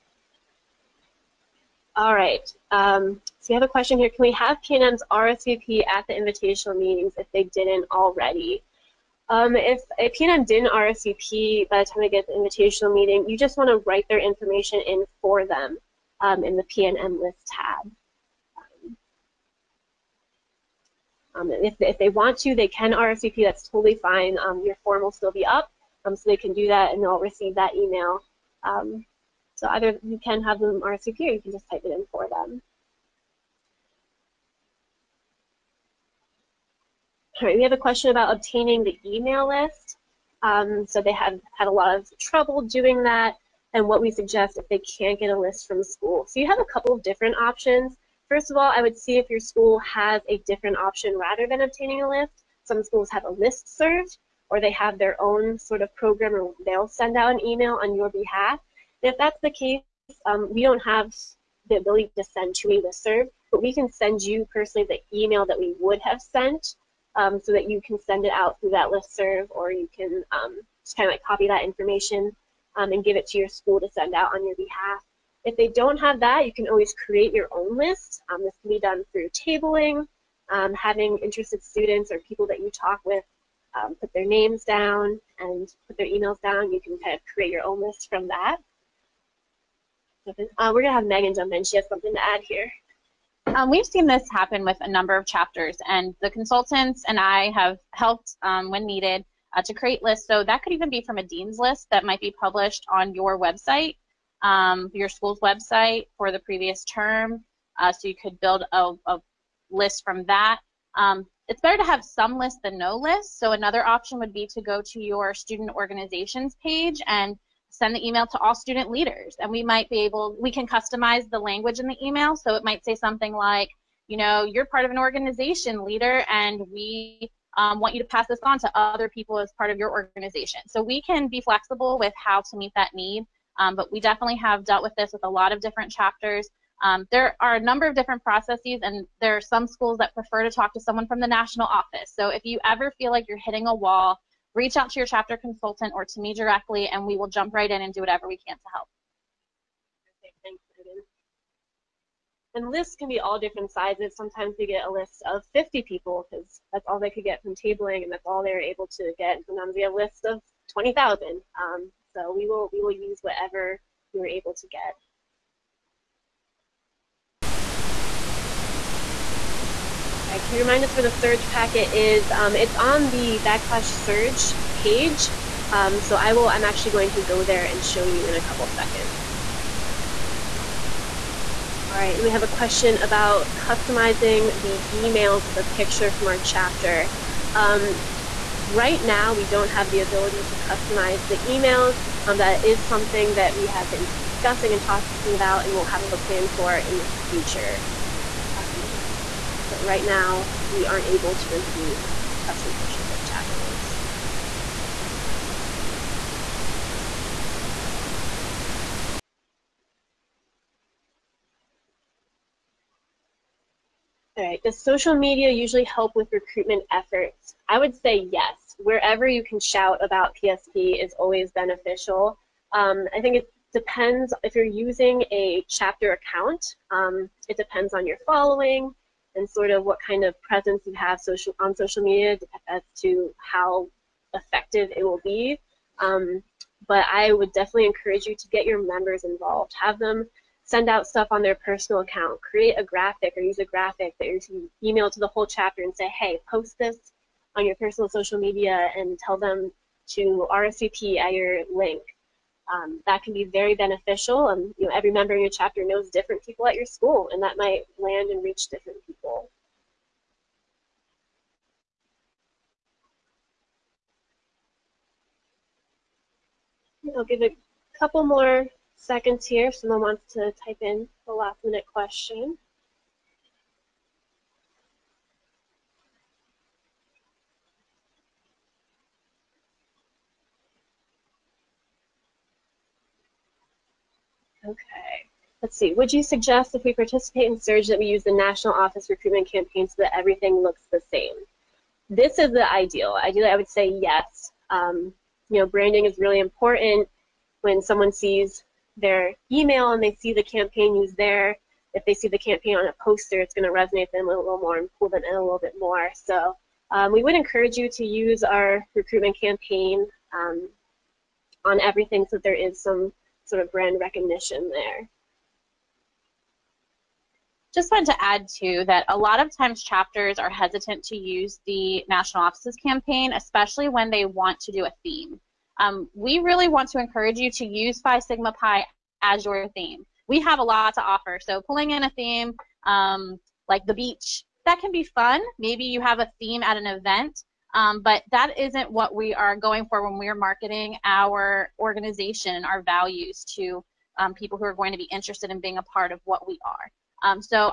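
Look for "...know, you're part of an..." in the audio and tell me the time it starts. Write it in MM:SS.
02:04.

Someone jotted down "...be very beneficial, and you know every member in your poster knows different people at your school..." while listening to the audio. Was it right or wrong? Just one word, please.
wrong.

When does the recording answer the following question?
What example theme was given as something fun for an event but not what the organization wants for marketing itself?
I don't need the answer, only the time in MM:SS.
05:33.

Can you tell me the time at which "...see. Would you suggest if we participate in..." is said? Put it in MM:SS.
04:45.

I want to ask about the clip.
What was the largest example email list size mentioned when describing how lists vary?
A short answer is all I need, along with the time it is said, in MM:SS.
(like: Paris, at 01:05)
20,000, at 02:40.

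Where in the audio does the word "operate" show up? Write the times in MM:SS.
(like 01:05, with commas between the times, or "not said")
not said.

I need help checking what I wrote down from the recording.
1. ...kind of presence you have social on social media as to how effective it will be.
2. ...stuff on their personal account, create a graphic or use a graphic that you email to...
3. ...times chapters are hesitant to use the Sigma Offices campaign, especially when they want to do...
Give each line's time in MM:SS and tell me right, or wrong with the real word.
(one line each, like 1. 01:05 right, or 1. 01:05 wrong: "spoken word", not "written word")
1. 03:50 right
2. 04:01 right
3. 05:19 wrong: "National", not "Sigma".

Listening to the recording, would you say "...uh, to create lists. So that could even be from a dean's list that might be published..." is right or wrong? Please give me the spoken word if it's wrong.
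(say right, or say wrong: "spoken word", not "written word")
right.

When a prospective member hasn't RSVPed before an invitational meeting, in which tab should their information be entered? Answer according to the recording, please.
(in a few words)
PNM list tab.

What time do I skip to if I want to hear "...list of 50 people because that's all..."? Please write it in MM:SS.
02:34.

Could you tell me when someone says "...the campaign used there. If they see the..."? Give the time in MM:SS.
05:00.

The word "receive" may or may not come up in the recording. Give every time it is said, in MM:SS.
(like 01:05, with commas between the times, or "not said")
00:27.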